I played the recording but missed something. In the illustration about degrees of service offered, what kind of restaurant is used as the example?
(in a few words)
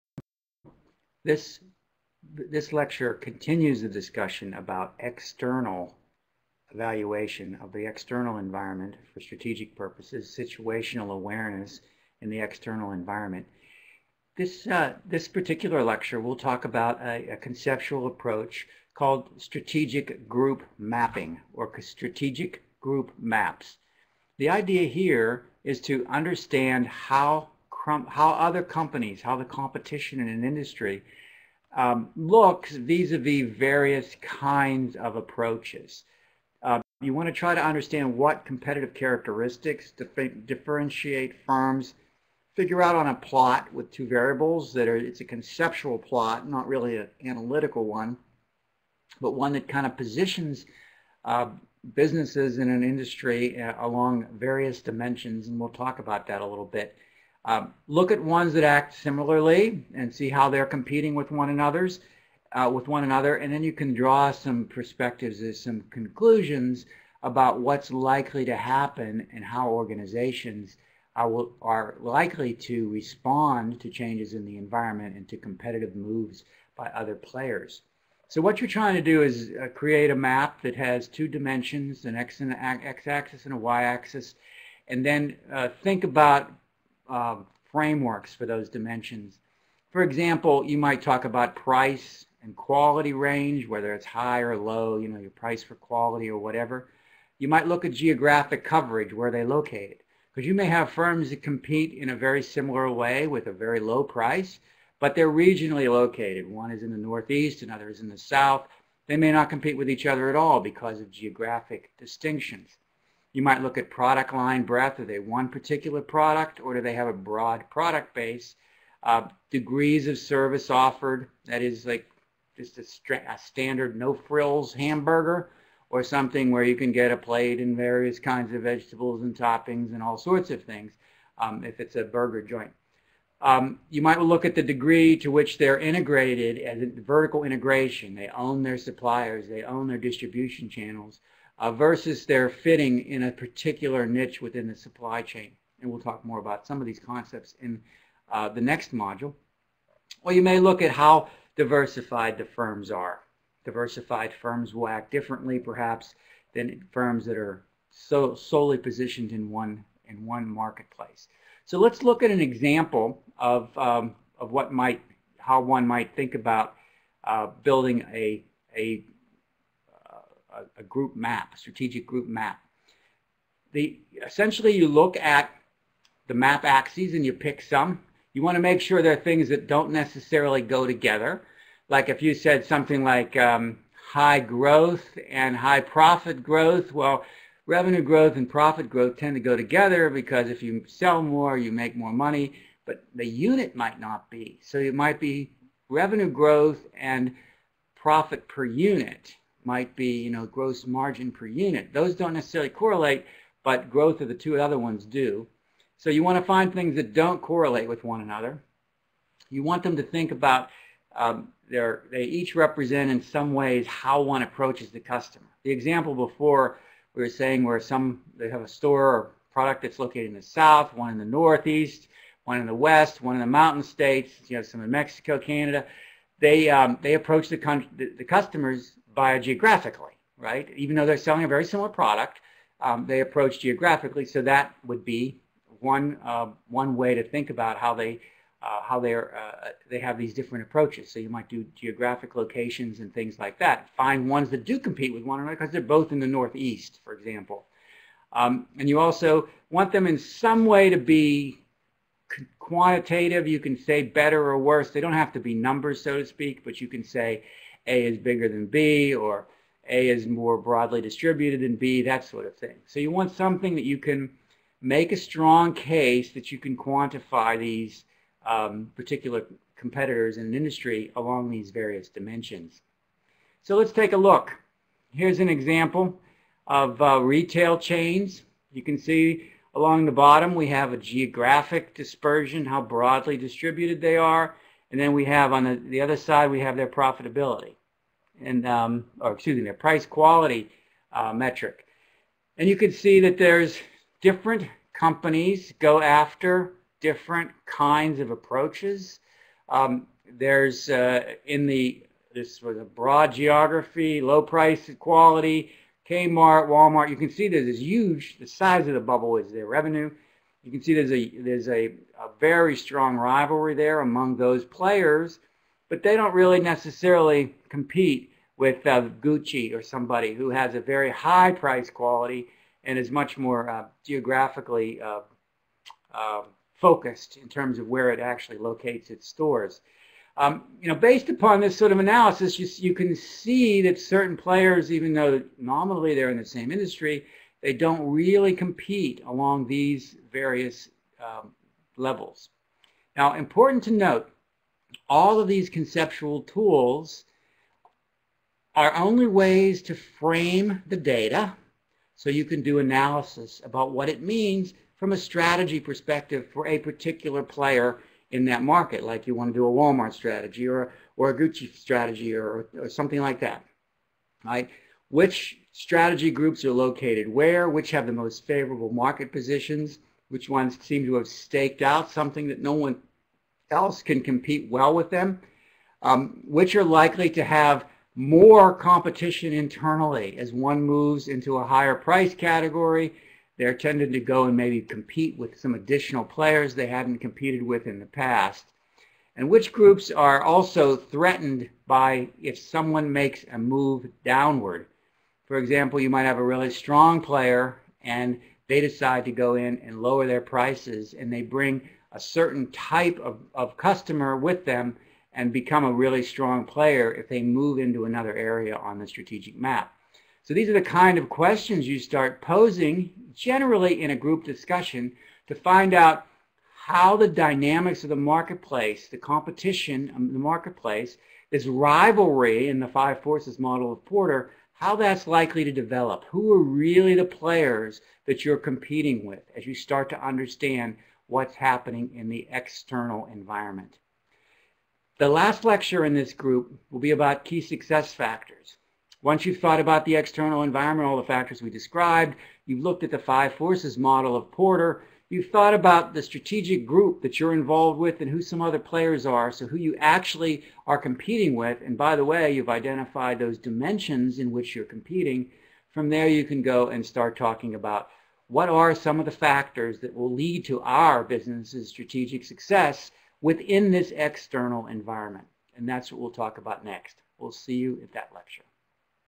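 A burger joint.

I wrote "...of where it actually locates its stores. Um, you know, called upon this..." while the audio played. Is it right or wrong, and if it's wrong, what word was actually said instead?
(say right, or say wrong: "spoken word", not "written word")
wrong: "based", not "called".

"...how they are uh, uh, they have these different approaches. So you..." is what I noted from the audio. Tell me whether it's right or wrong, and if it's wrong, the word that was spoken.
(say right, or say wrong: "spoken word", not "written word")
right.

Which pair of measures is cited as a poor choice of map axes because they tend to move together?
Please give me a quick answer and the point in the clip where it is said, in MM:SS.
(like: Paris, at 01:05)
Revenue growth and profit growth, at 03:07.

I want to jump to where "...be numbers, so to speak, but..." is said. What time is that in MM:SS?
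04:15.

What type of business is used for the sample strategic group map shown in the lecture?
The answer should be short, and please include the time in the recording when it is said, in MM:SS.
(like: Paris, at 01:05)
Retail chains, at 04:37.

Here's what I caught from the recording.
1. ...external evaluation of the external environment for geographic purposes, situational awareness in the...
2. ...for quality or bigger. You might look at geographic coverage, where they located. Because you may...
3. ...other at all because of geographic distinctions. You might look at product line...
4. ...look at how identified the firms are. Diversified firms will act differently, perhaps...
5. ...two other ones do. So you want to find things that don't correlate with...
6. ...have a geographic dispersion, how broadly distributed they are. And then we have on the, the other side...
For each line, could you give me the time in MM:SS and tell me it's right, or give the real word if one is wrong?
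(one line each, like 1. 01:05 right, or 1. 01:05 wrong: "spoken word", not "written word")
1. 00:04 wrong: "strategic", not "geographic"
2. 01:35 wrong: "whatever", not "bigger"
3. 01:50 right
4. 02:30 wrong: "diversified", not "identified"
5. 03:24 right
6. 04:40 right.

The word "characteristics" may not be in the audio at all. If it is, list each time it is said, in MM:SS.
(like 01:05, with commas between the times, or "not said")
00:38.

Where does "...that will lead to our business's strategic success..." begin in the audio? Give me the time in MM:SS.
07:40.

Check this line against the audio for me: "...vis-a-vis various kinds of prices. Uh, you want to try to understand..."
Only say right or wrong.
wrong.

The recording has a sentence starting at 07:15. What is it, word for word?
The last lecture in this group will be about key success factors.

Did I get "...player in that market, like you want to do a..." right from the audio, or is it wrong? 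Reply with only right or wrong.
right.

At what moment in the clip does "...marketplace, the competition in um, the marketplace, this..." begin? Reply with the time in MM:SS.
06:58.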